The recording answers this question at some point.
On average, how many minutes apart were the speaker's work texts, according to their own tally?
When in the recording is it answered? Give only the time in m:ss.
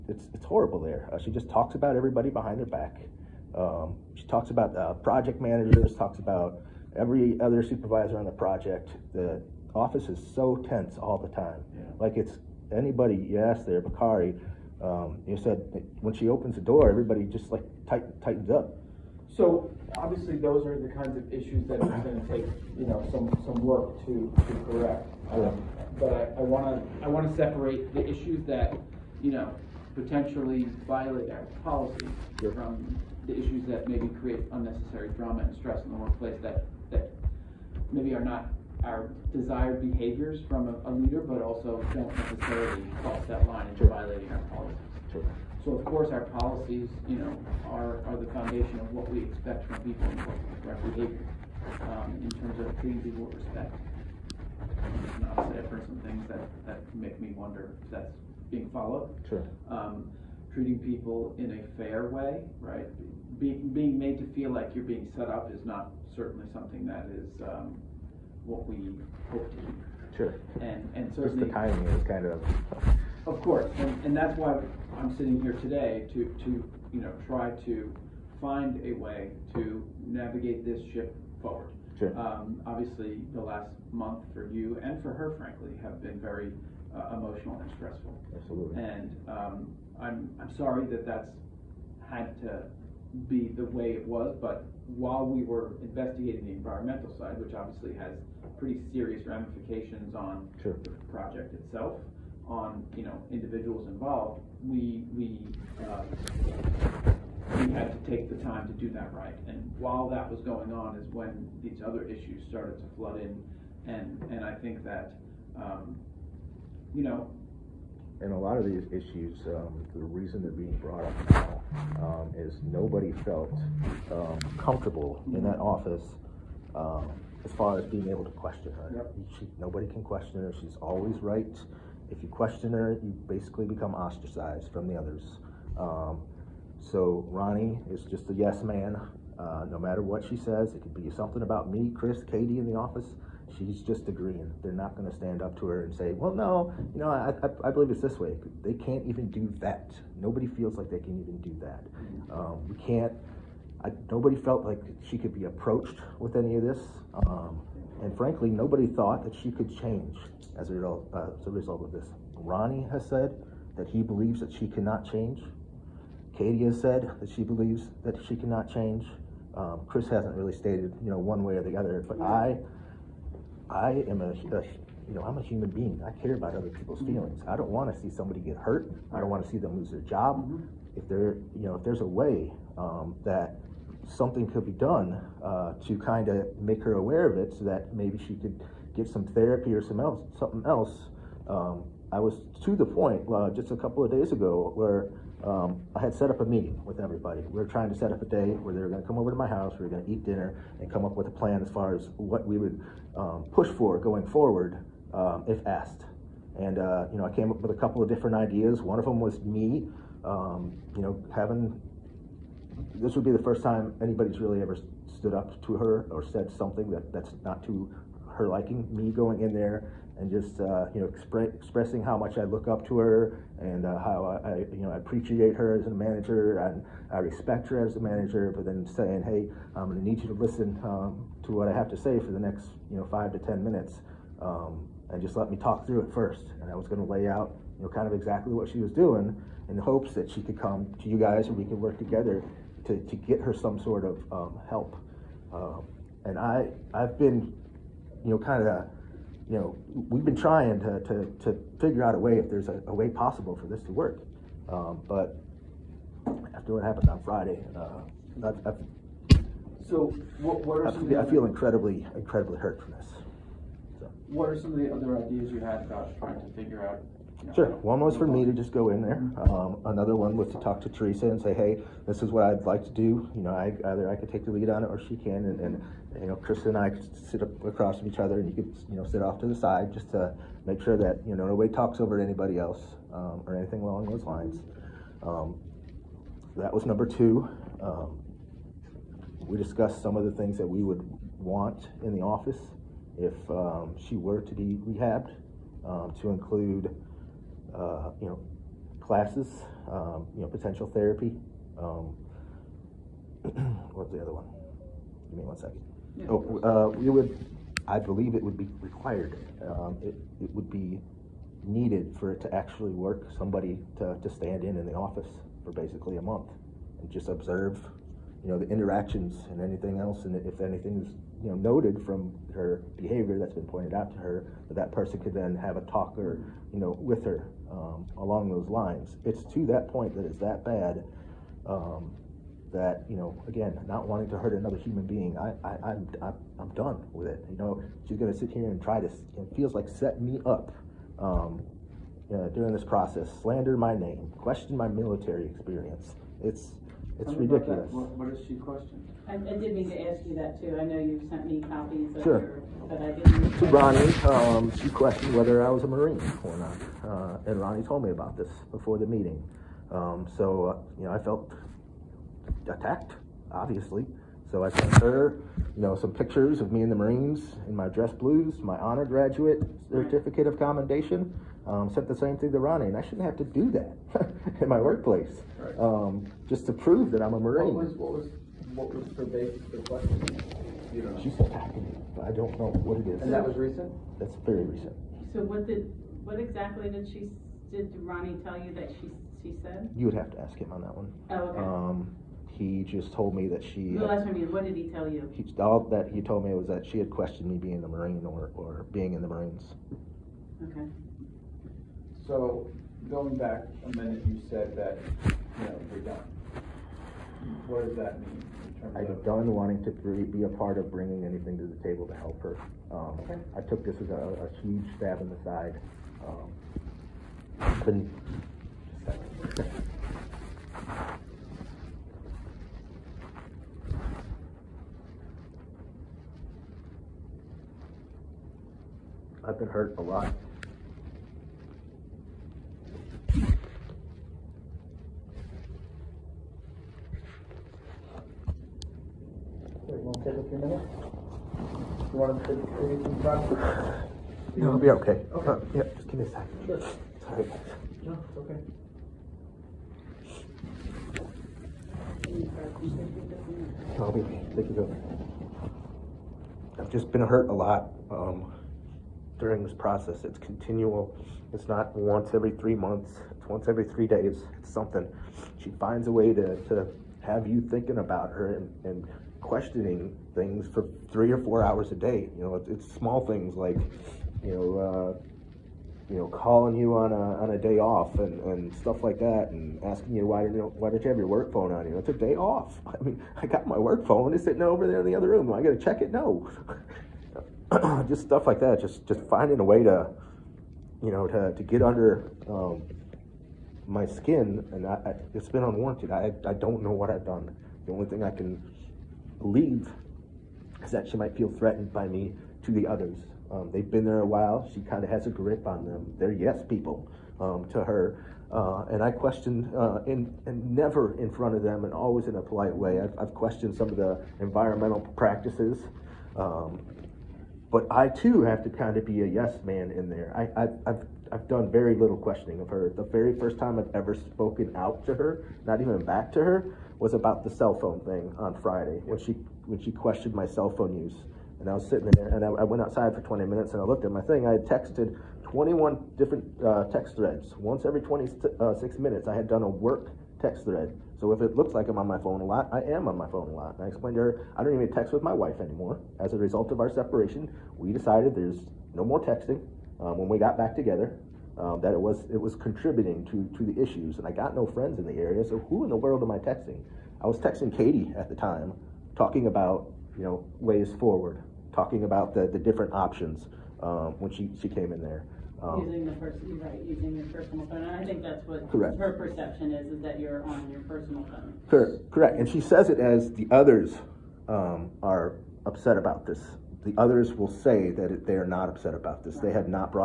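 8:58.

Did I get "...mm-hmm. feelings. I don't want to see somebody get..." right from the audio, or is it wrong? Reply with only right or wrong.
right.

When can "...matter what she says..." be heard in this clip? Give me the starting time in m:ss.
2:19.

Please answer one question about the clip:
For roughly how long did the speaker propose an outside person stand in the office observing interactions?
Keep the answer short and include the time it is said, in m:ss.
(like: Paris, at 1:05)
a month, at 5:15.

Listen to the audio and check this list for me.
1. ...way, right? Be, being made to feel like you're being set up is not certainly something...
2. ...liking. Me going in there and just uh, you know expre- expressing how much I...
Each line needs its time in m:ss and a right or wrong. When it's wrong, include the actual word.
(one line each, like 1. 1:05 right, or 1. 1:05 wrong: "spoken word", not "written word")
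1. 1:02 right
2. 3:38 right.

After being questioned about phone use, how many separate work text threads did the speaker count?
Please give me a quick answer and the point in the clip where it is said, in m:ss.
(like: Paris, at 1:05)
21, at 8:55.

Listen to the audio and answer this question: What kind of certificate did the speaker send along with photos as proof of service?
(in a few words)
honor graduate certificate.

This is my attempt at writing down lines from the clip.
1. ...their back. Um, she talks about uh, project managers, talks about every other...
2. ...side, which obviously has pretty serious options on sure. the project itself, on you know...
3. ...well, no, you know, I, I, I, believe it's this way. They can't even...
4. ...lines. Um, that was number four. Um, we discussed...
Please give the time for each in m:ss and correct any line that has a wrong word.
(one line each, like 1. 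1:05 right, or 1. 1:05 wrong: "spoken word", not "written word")
1. 0:02 right
2. 1:37 wrong: "ramifications", not "options"
3. 2:26 right
4. 4:44 wrong: "two", not "four".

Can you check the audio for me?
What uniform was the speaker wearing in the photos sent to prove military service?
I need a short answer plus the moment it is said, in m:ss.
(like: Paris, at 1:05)
dress blues, at 6:07.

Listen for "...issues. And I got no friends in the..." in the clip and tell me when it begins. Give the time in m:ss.
9:13.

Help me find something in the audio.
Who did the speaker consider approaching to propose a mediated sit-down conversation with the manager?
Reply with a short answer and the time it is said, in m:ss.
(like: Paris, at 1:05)
Teresa, at 4:30.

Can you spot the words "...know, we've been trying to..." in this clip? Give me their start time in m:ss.
4:09.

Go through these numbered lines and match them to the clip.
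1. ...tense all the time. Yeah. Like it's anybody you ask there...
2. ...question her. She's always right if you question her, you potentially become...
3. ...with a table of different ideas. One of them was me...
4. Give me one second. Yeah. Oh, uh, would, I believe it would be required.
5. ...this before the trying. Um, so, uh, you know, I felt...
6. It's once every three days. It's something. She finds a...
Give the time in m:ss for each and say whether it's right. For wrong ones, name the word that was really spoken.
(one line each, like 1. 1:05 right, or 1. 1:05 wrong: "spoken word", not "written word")
1. 0:10 right
2. 2:10 wrong: "basically", not "potentially"
3. 3:27 wrong: "couple", not "table"
4. 5:05 right
5. 5:58 wrong: "meeting", not "trying"
6. 7:43 right.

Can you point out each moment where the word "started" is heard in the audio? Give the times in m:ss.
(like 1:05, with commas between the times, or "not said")
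1:52.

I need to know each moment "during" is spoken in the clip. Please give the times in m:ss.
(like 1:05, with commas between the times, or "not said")
5:42, 7:39.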